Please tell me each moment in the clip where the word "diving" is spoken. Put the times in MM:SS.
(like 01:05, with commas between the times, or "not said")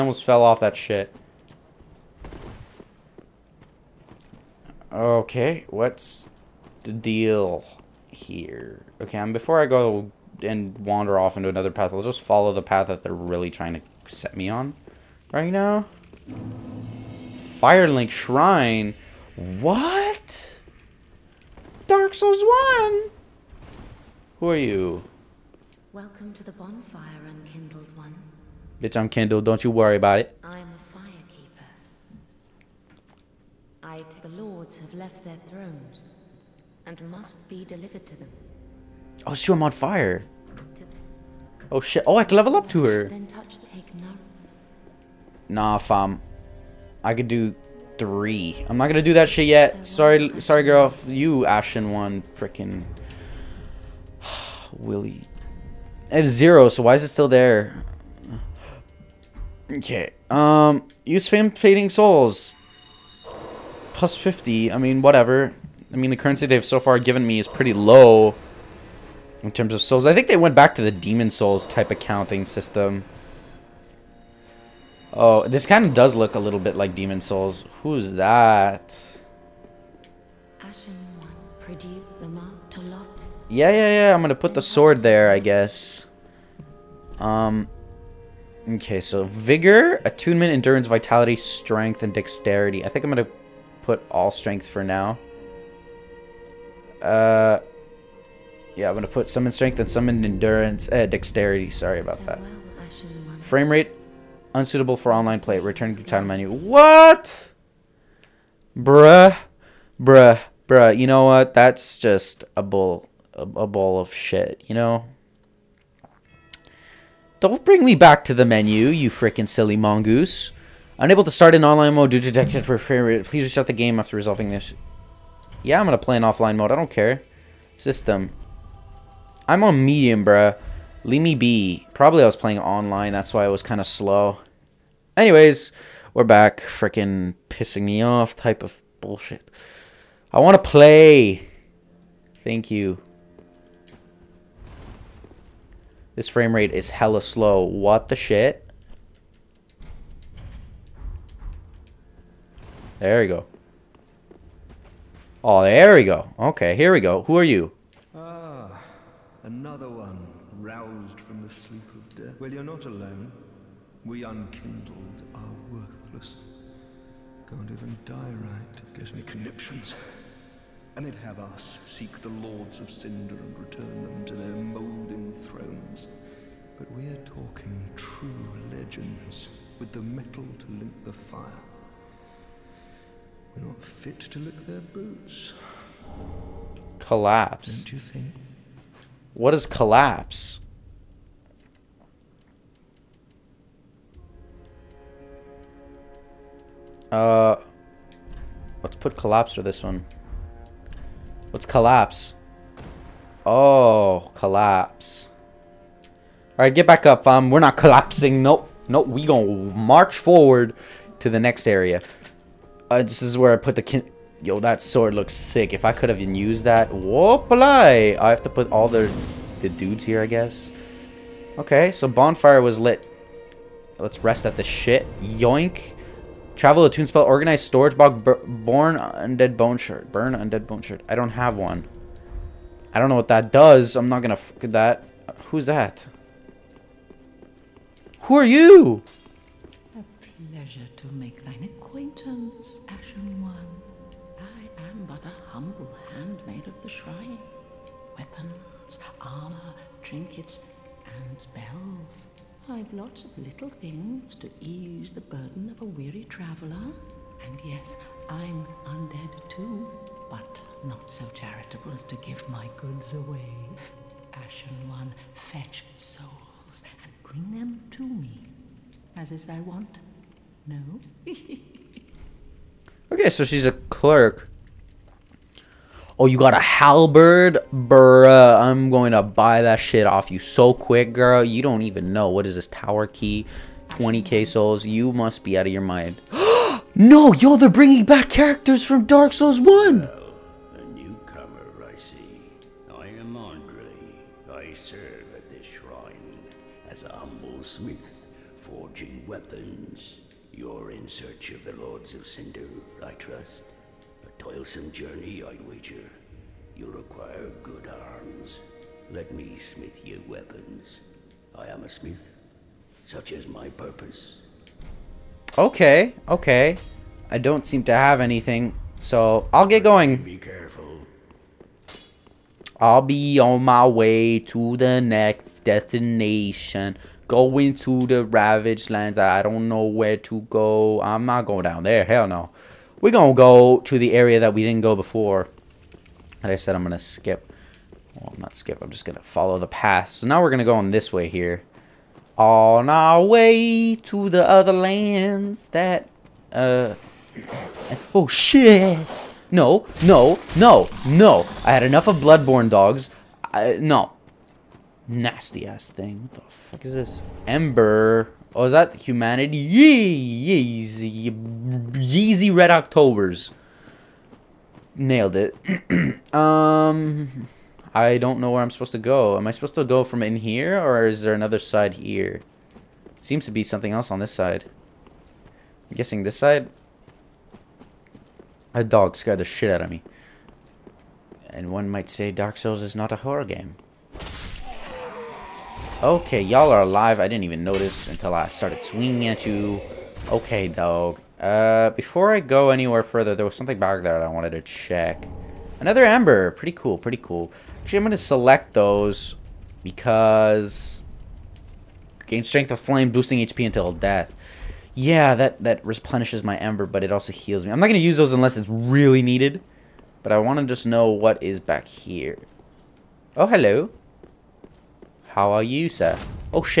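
not said.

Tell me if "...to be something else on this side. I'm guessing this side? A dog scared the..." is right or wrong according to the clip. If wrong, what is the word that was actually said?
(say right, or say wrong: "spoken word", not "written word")
right.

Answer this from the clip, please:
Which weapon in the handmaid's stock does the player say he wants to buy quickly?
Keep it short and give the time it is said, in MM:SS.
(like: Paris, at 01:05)
halberd, at 04:36.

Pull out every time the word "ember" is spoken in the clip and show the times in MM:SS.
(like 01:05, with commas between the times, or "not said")
05:57, 06:36, 06:46.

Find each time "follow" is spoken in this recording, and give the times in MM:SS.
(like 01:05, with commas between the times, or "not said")
00:12, 05:39.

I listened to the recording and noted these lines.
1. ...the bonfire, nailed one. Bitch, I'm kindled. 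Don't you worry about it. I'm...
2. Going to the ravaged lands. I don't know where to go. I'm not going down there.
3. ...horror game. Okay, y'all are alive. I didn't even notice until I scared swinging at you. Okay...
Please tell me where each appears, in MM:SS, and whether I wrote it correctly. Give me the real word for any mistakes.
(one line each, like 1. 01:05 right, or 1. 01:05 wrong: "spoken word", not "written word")
1. 00:26 wrong: "unkindled", not "nailed"
2. 05:27 right
3. 06:23 wrong: "started", not "scared".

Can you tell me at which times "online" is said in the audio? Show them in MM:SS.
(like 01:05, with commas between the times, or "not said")
01:45, 02:01, 02:12.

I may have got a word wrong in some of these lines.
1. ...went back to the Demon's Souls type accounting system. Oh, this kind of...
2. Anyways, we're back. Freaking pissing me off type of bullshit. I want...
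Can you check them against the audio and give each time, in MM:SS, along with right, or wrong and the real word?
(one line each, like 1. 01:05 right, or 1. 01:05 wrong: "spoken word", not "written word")
1. 01:10 right
2. 02:15 right.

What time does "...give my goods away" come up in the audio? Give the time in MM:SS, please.
04:22.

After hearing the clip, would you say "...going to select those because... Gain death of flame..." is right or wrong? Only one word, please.
wrong.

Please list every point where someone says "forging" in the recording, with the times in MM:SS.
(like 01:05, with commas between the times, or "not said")
04:58.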